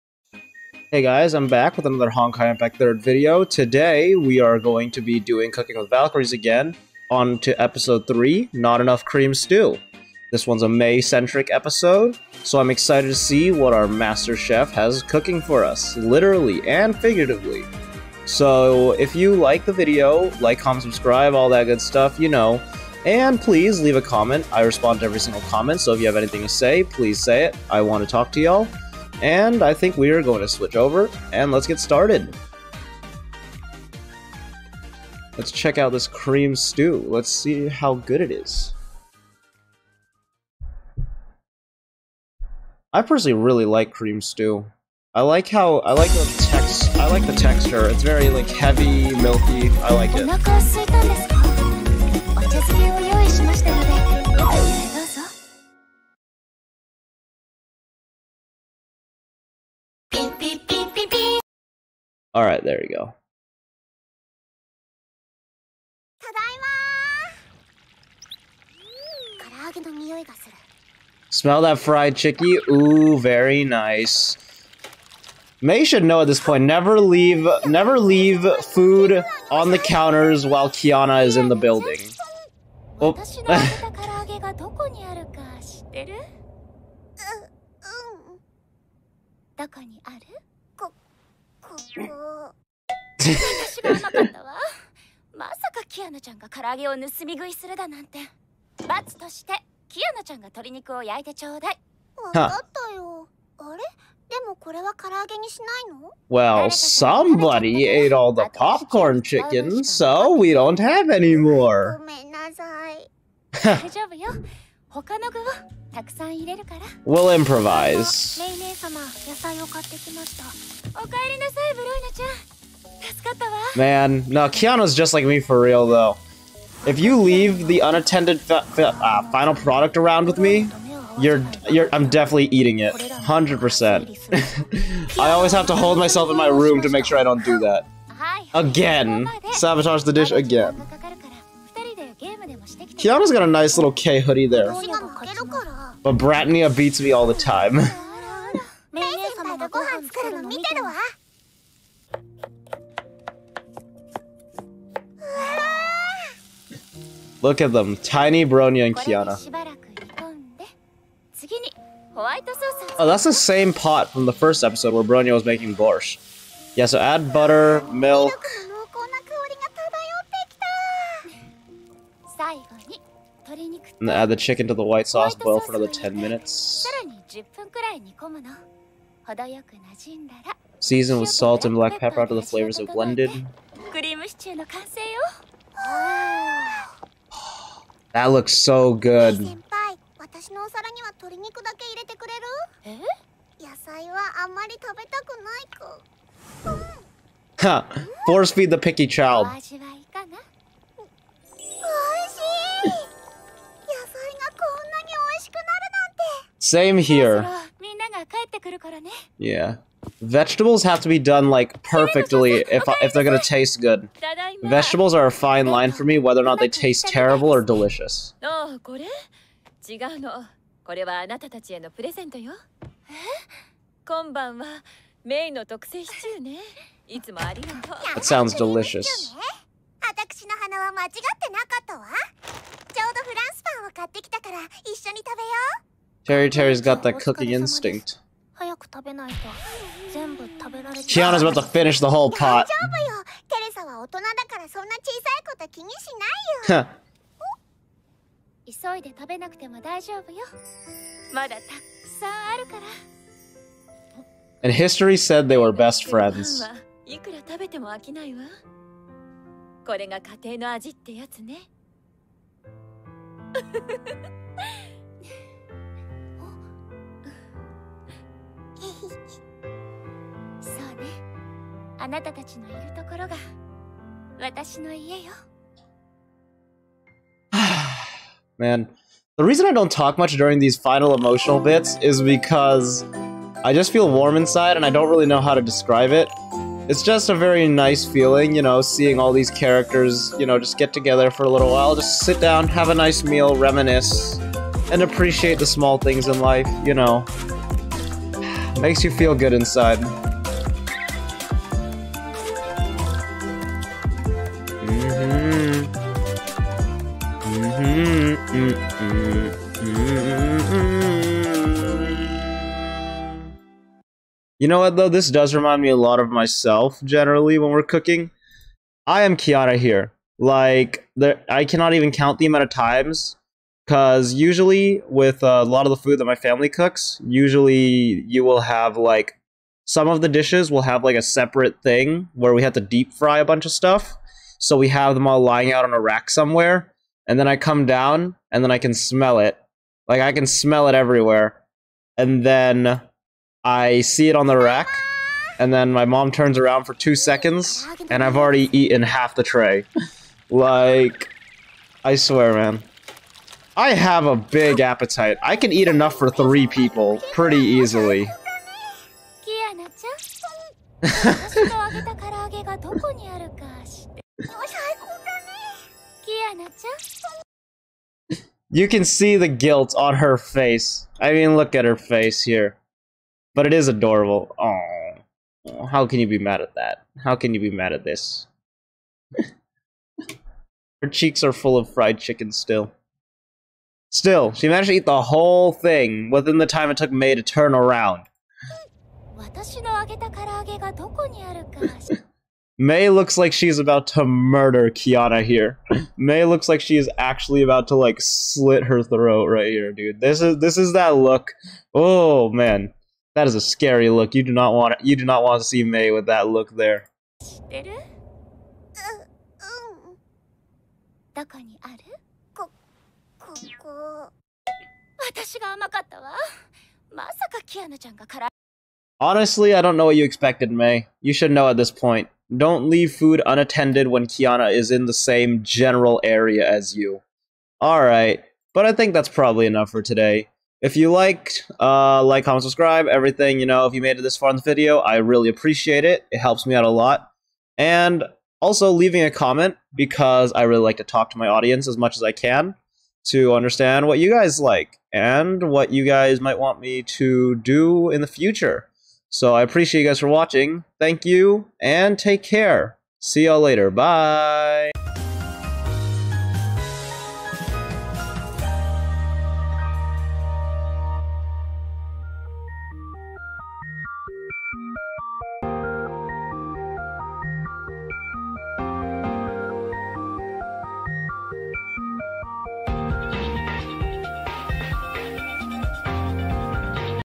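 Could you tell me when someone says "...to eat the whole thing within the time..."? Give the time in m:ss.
6:24.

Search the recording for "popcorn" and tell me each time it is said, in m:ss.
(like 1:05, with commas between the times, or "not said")
1:48.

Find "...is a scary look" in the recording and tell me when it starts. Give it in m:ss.
6:43.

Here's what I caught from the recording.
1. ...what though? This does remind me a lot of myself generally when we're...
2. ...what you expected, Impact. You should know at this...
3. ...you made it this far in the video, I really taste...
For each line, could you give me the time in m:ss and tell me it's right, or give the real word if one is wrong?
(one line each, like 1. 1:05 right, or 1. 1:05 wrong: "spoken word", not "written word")
1. 5:14 right
2. 7:00 wrong: "Mei", not "Impact"
3. 7:13 wrong: "appreciate", not "taste".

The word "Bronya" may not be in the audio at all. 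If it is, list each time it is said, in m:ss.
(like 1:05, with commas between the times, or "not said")
2:26, 2:38, 2:45.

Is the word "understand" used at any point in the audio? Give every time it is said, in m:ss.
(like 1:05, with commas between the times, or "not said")
7:23.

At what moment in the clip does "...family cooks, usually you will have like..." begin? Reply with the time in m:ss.
5:26.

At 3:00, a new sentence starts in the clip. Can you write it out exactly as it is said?
Season with salt and black pepper until the flavors are blended.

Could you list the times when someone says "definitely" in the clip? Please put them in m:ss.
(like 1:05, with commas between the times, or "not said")
2:12.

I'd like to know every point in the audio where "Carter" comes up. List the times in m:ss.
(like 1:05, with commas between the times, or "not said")
not said.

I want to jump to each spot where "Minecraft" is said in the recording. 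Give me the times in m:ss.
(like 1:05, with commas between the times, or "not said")
not said.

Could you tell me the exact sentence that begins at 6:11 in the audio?
I mean, look at her face here.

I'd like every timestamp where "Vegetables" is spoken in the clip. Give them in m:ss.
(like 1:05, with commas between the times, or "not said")
3:30, 3:34.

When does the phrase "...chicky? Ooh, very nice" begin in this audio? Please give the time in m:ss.
1:12.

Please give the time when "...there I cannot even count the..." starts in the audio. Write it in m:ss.
5:21.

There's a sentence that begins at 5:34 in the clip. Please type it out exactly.
So we have them all lying out on a rack somewhere.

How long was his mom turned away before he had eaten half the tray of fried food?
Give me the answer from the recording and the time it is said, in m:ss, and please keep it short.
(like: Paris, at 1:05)
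2 seconds, at 5:46.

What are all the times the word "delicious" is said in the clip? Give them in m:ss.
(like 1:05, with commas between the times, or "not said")
3:37, 3:48.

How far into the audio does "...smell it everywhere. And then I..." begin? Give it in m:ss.
5:40.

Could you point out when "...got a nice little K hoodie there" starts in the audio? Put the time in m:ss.
2:23.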